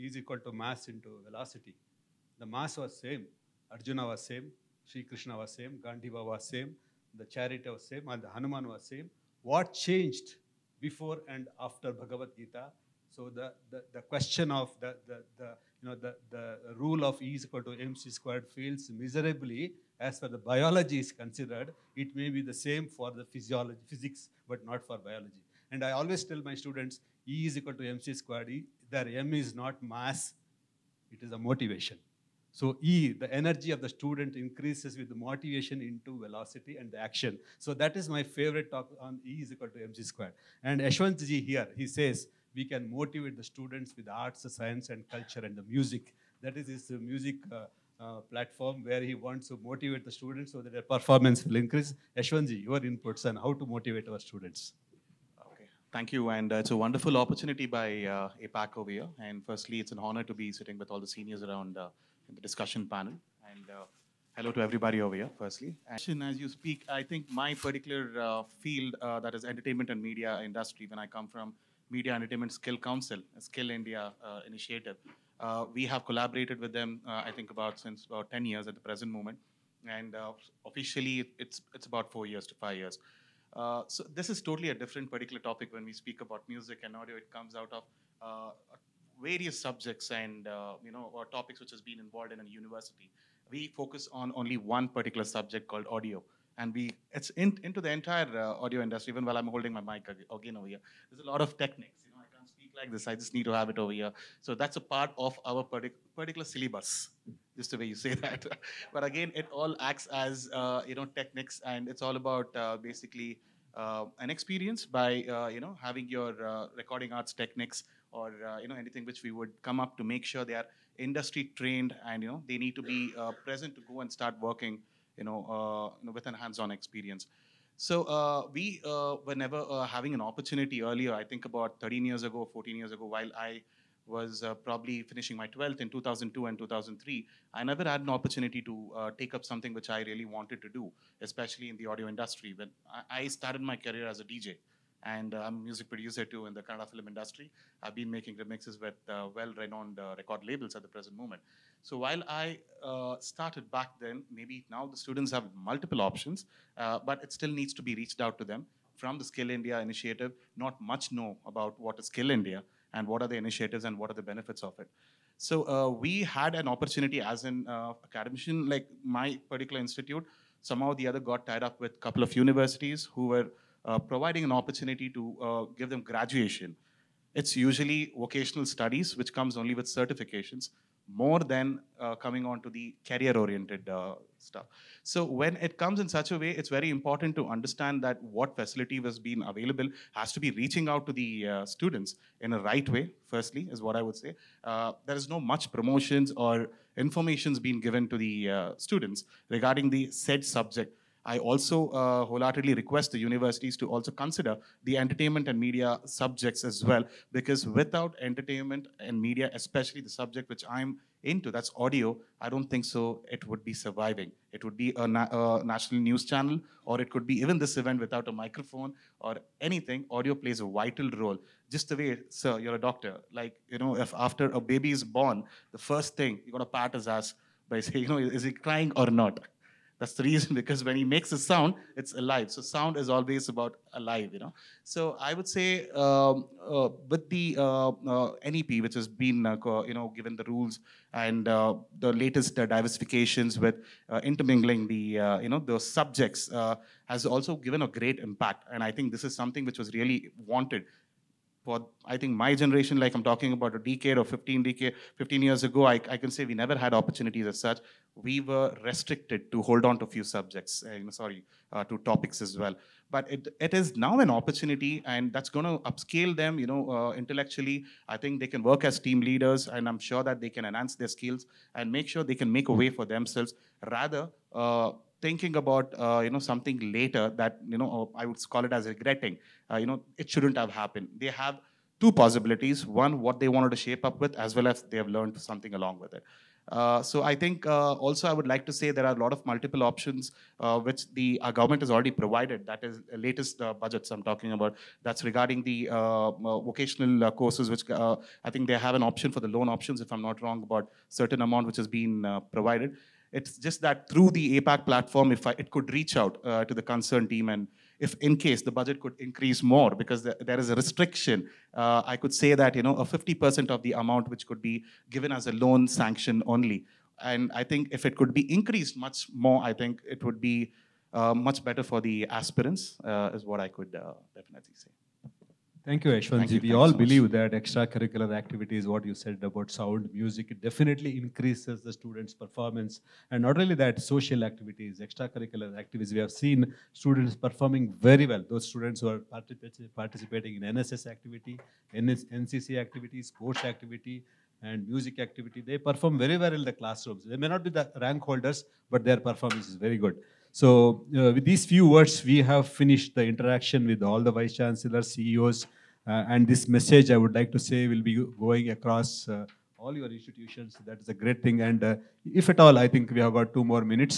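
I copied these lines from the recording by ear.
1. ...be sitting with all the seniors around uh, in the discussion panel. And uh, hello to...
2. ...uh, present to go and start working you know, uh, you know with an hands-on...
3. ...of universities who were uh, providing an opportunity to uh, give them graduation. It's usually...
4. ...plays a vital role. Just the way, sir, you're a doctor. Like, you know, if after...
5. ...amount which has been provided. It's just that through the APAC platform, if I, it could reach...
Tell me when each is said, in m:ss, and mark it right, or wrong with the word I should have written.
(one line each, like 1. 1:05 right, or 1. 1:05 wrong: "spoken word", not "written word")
1. 1:00 right
2. 2:03 right
3. 2:52 right
4. 3:40 right
5. 5:01 right.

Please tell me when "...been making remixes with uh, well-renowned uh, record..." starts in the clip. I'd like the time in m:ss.
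2:27.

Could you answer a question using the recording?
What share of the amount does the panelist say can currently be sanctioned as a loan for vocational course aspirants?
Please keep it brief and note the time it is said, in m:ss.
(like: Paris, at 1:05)
50%, at 5:13.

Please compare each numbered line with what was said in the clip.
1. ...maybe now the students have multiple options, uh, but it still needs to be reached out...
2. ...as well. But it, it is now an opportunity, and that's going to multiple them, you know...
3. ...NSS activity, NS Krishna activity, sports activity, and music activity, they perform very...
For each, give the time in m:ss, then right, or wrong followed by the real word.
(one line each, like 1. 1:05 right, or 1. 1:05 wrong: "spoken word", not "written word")
1. 2:34 right
2. 4:22 wrong: "upscale", not "multiple"
3. 5:40 wrong: "NCC", not "Krishna".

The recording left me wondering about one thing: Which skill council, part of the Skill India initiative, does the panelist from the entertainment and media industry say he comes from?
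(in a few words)
Media Entertainment Skill Council.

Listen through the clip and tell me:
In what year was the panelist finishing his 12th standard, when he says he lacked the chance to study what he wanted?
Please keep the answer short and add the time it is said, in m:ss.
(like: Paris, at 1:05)
2002, at 2:15.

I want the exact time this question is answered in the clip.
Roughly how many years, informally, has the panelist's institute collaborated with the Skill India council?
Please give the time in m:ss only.
1:18.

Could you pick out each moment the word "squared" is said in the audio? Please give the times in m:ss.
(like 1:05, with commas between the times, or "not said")
0:18, 0:28, 0:40.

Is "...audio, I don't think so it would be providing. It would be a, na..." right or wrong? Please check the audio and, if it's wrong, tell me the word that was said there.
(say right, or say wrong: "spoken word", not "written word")
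wrong: "surviving", not "providing".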